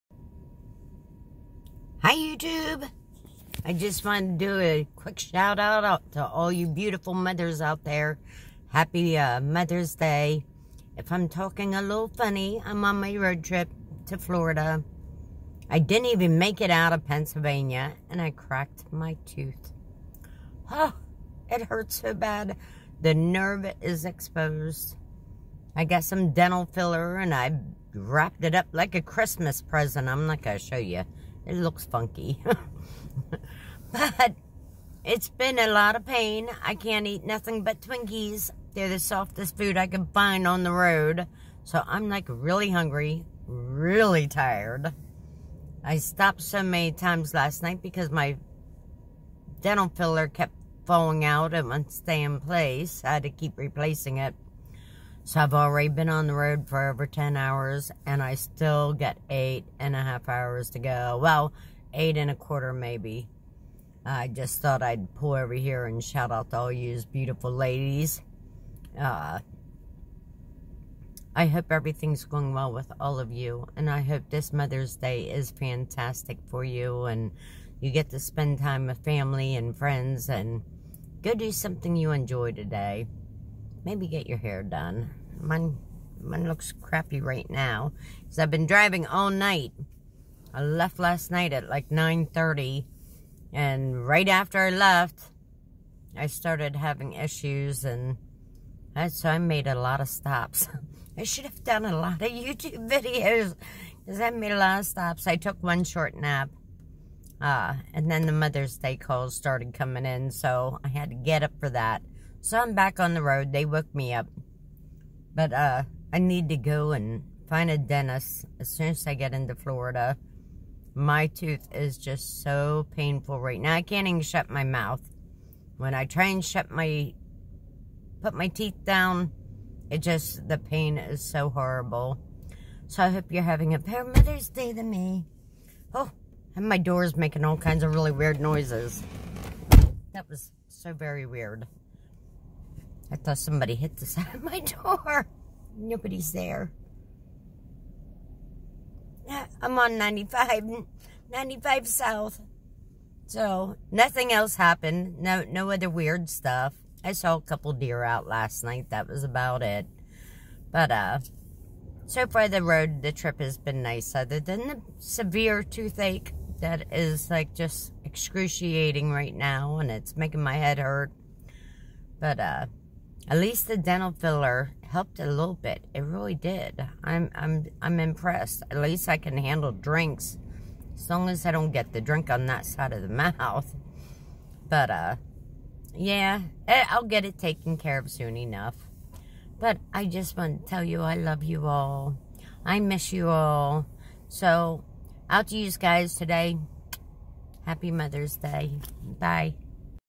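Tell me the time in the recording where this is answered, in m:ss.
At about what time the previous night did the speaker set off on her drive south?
1:31.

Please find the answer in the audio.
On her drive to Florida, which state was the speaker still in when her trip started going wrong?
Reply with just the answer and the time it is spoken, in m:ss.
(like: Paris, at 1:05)
Pennsylvania, at 0:17.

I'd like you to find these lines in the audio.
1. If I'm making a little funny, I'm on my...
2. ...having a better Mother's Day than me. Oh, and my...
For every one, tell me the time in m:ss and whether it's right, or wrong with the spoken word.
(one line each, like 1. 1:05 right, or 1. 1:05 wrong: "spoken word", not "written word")
1. 0:10 wrong: "talking", not "making"
2. 2:13 right.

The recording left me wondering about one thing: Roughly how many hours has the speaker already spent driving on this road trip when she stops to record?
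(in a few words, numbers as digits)
over 10 hours.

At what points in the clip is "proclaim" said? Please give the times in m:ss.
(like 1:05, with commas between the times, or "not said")
not said.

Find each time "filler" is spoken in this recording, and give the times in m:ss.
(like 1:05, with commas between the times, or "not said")
0:26, 0:49, 2:54.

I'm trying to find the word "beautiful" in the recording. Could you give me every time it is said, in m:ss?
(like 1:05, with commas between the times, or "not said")
0:06, 1:07.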